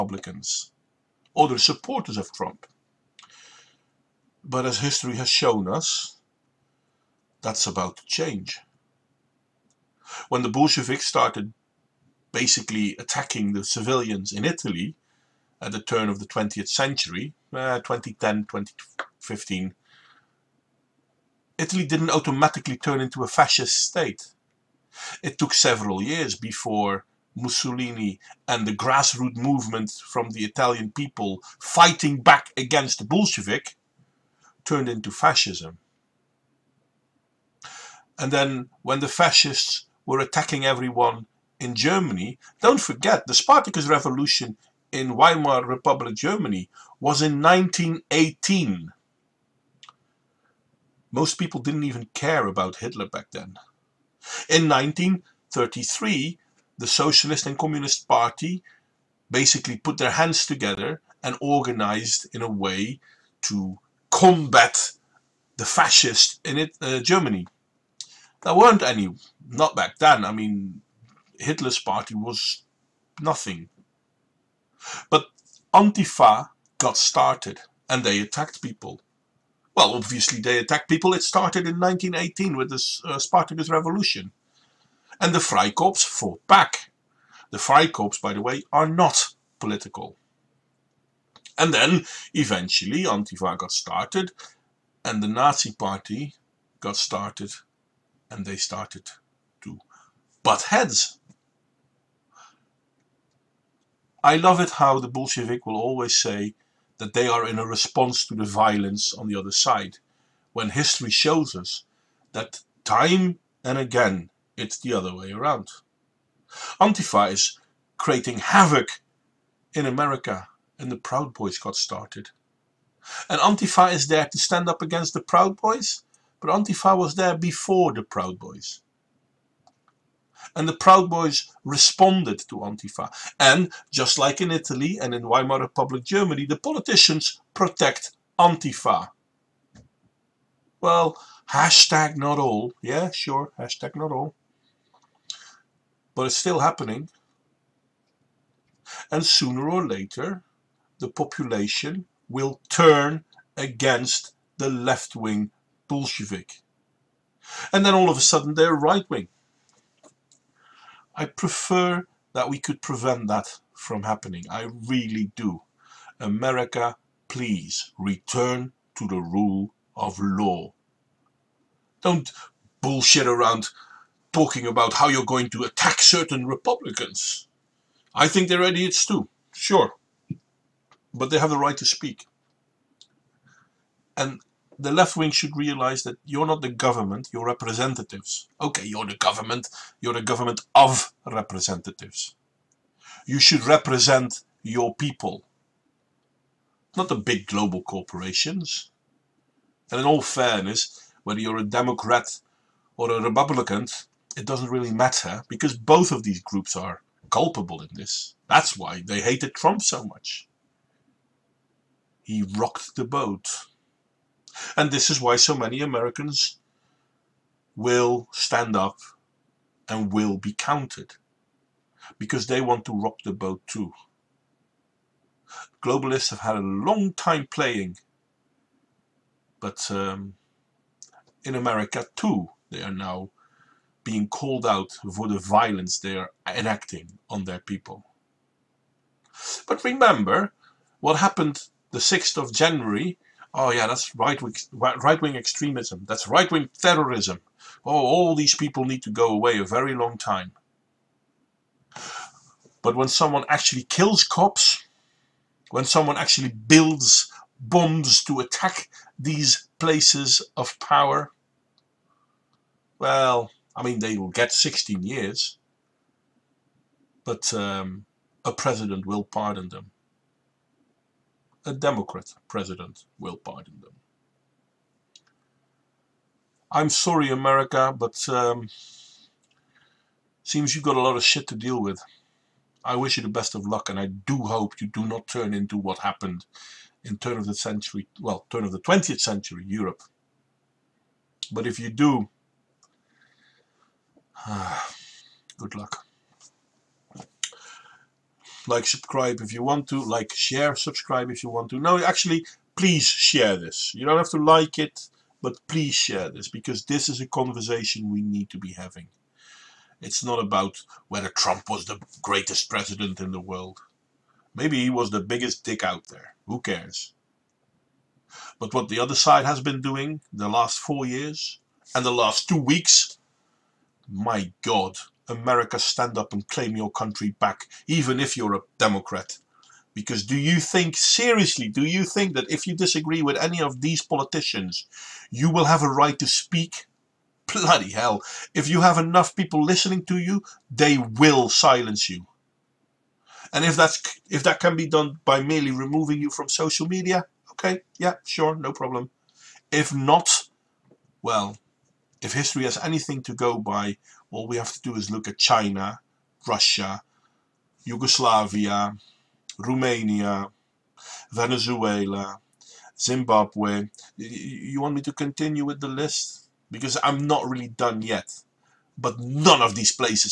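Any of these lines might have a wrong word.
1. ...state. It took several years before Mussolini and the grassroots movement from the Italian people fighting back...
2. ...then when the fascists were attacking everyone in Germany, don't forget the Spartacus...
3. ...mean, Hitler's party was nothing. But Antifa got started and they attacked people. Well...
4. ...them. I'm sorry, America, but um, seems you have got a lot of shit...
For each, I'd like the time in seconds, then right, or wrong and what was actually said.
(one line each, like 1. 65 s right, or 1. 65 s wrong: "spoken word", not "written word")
1. 23 s right
2. 38 s right
3. 70 s right
4. 273 s right.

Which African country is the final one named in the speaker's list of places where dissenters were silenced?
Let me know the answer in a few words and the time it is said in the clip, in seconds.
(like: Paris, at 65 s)
Zimbabwe, at 362 s.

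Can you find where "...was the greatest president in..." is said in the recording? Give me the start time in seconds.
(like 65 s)
311 s.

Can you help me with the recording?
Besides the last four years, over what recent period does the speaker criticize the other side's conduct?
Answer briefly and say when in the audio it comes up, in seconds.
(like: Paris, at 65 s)
the last two weeks, at 322 s.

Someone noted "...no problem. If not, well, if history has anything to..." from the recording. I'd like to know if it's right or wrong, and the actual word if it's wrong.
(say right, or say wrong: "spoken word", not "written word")
right.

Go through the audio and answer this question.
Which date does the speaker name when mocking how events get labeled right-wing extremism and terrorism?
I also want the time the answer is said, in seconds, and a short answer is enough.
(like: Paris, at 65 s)
6th of January, at 241 s.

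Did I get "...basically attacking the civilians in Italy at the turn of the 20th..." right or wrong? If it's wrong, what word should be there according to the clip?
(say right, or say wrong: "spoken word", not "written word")
right.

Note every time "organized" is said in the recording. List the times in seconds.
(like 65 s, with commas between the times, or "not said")
61 s.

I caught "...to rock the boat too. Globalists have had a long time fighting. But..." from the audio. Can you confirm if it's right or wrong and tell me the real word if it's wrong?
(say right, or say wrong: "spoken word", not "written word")
wrong: "playing", not "fighting".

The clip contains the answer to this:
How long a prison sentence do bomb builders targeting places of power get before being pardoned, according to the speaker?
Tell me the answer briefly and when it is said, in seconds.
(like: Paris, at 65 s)
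16 years, at 264 s.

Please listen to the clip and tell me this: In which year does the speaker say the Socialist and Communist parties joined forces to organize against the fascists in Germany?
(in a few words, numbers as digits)
1933.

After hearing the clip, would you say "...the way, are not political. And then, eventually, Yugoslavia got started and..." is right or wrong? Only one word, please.
wrong.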